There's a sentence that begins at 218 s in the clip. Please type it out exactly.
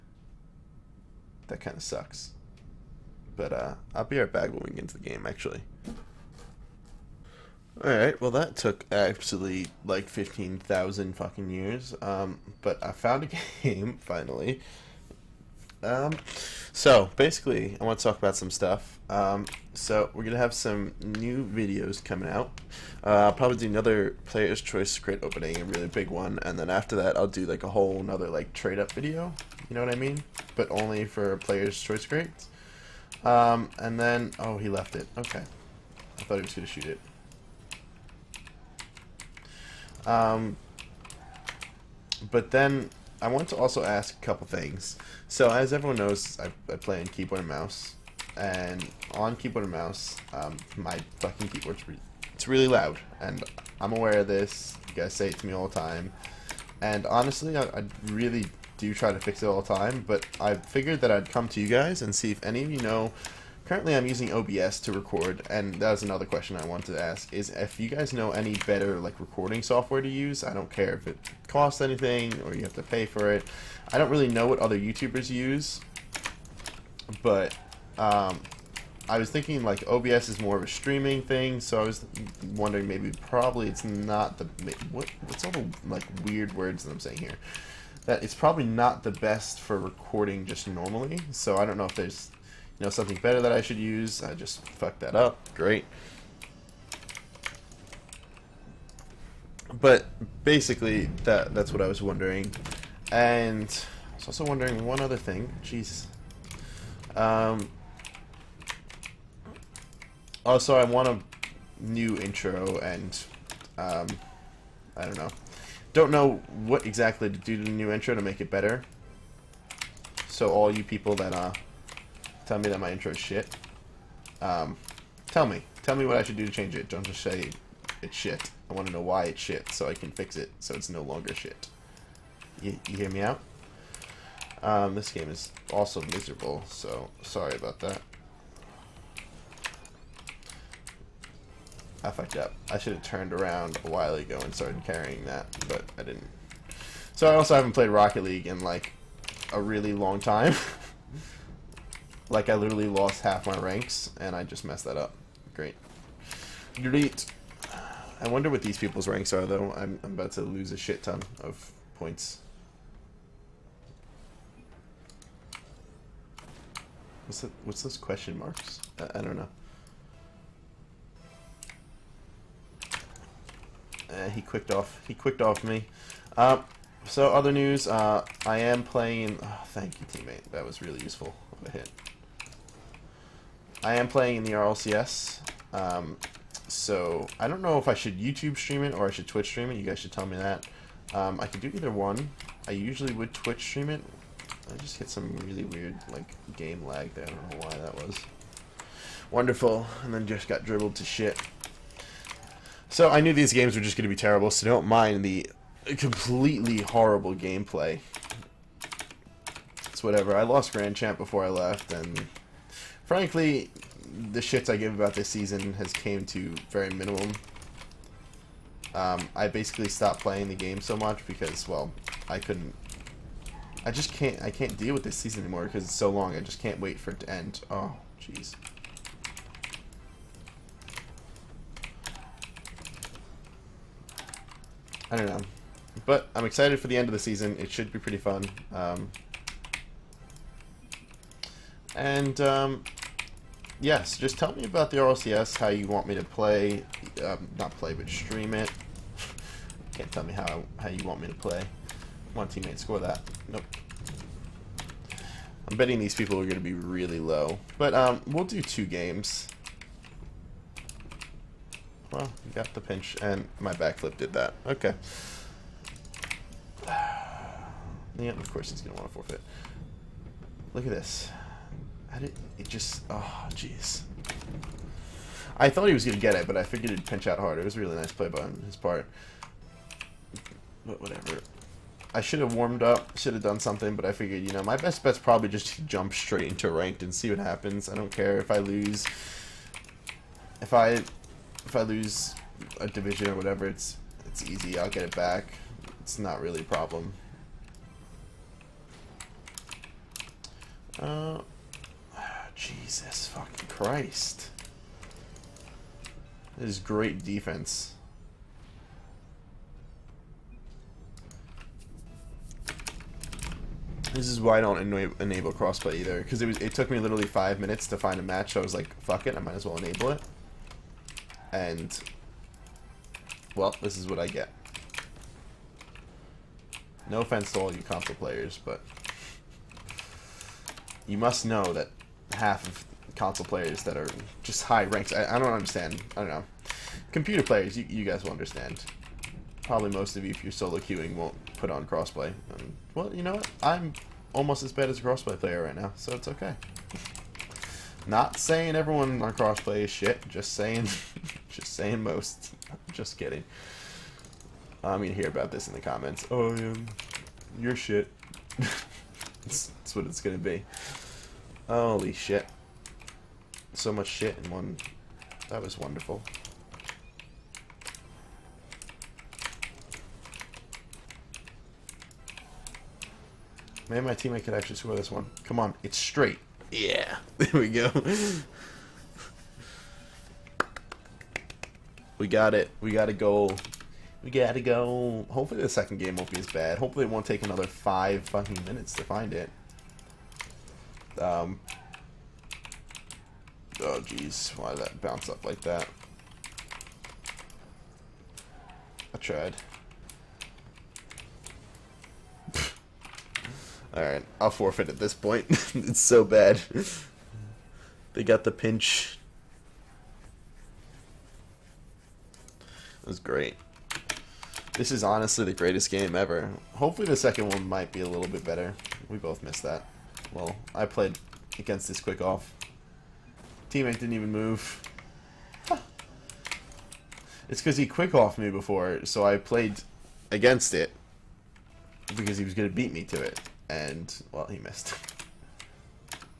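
Um, I basically stopped playing the game so much because, well, I couldn't...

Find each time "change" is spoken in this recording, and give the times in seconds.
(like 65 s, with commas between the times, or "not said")
126 s.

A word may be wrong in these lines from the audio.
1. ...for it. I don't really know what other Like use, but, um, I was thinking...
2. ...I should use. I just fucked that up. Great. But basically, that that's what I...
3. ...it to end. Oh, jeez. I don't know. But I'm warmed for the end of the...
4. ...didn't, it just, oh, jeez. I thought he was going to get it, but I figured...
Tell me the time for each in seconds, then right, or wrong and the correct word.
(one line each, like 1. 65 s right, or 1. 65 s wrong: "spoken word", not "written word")
1. 73 s wrong: "YouTubers", not "Like"
2. 93 s right
3. 227 s wrong: "excited", not "warmed"
4. 272 s right.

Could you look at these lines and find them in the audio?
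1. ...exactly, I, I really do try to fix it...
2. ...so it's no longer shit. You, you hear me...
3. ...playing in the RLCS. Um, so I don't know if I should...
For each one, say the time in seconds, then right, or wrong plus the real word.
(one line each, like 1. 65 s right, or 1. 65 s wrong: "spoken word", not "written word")
1. 57 s wrong: "honestly", not "exactly"
2. 130 s right
3. 184 s right.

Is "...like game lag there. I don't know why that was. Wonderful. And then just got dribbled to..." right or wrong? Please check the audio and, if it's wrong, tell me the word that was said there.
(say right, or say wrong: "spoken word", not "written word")
right.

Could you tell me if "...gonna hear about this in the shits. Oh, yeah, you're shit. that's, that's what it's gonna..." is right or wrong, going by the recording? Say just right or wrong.
wrong.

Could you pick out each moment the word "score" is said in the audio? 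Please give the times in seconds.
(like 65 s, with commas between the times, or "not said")
252 s, 374 s.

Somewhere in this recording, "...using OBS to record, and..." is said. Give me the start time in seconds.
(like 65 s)
64 s.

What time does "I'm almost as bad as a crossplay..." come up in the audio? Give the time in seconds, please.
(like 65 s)
343 s.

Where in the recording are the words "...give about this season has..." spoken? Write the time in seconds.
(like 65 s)
214 s.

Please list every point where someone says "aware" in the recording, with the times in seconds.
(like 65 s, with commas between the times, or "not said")
53 s.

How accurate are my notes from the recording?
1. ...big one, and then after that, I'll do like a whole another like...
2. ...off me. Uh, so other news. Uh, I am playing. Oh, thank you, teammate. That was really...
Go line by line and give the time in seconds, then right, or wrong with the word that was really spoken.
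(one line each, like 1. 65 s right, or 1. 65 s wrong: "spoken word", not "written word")
1. 25 s right
2. 175 s right.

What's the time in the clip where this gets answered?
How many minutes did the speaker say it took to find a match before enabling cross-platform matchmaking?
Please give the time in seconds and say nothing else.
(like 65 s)
317 s.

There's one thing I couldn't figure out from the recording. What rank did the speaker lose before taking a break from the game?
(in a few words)
Grand Champ.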